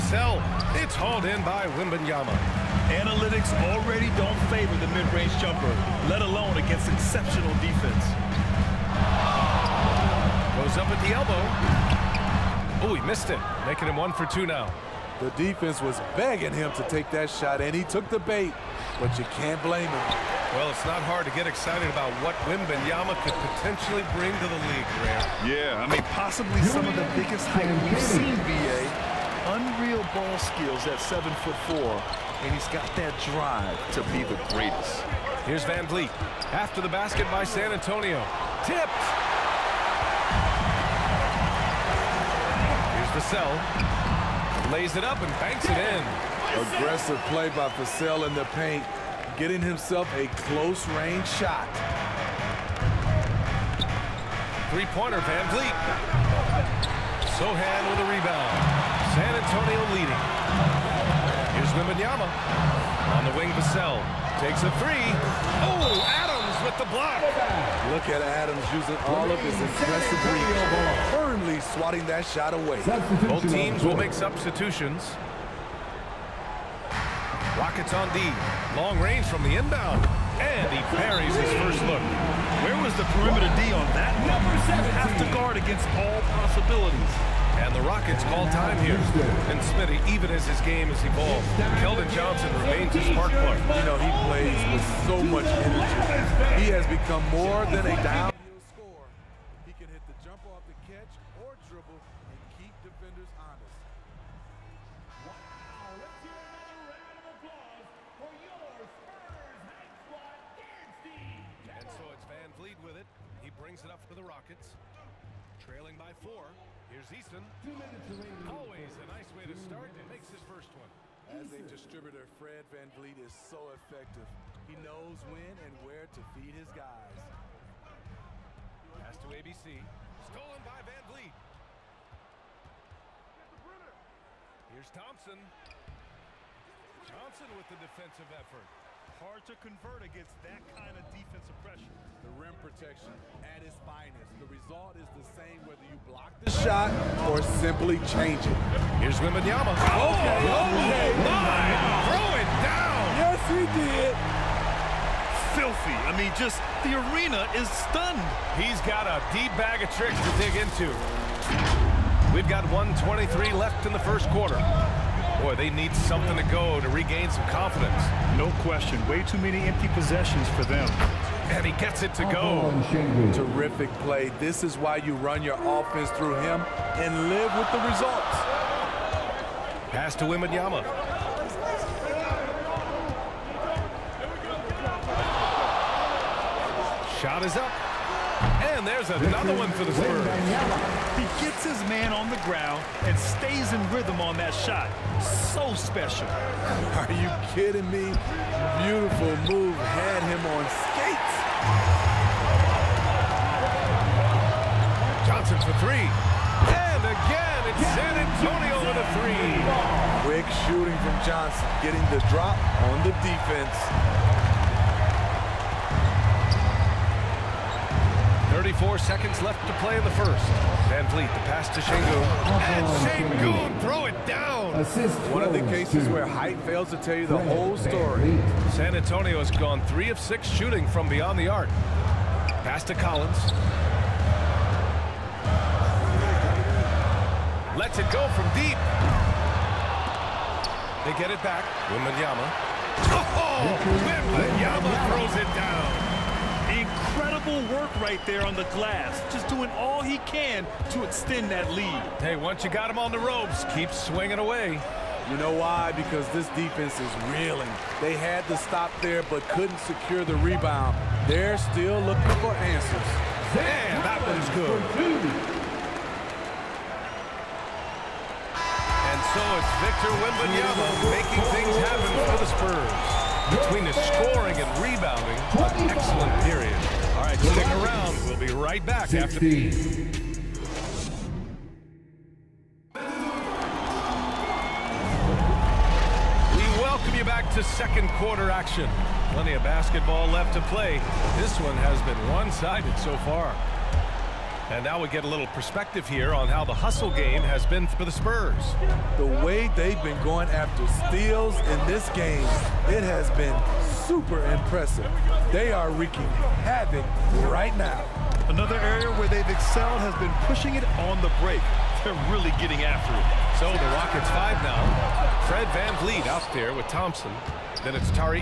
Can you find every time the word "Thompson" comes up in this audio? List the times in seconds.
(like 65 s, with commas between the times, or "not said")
134 s, 316 s.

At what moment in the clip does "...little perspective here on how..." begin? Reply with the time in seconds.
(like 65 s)
295 s.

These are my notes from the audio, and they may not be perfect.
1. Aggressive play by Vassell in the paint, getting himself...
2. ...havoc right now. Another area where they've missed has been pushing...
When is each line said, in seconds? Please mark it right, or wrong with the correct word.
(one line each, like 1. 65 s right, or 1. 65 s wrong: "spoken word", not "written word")
1. 46 s right
2. 306 s wrong: "excelled", not "missed".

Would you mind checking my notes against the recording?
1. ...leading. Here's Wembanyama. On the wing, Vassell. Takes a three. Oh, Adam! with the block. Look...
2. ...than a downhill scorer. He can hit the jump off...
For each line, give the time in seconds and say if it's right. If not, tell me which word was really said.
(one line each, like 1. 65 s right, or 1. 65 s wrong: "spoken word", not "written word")
1. 59 s right
2. 97 s right.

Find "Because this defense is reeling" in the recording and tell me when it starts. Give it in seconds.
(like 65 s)
255 s.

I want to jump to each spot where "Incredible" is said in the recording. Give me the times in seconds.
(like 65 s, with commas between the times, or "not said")
247 s.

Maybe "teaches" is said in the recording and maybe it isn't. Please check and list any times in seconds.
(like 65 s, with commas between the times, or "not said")
not said.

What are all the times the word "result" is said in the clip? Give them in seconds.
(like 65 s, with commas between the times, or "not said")
144 s, 177 s.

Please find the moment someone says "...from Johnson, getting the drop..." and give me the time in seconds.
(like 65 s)
211 s.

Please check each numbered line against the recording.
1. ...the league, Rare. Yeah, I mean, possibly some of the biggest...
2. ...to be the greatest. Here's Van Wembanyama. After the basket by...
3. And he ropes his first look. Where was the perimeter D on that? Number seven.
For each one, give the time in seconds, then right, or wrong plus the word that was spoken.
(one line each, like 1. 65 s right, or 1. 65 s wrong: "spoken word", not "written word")
1. 24 s right
2. 33 s wrong: "Vleet", not "Wembanyama"
3. 80 s wrong: "parries", not "ropes".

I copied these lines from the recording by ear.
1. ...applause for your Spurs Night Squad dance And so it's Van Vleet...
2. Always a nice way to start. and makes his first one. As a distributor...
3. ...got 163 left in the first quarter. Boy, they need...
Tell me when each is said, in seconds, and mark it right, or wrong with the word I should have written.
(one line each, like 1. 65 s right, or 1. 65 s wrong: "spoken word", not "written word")
1. 107 s right
2. 118 s right
3. 162 s wrong: "123", not "163".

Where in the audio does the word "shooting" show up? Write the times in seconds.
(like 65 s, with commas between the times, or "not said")
210 s, 230 s.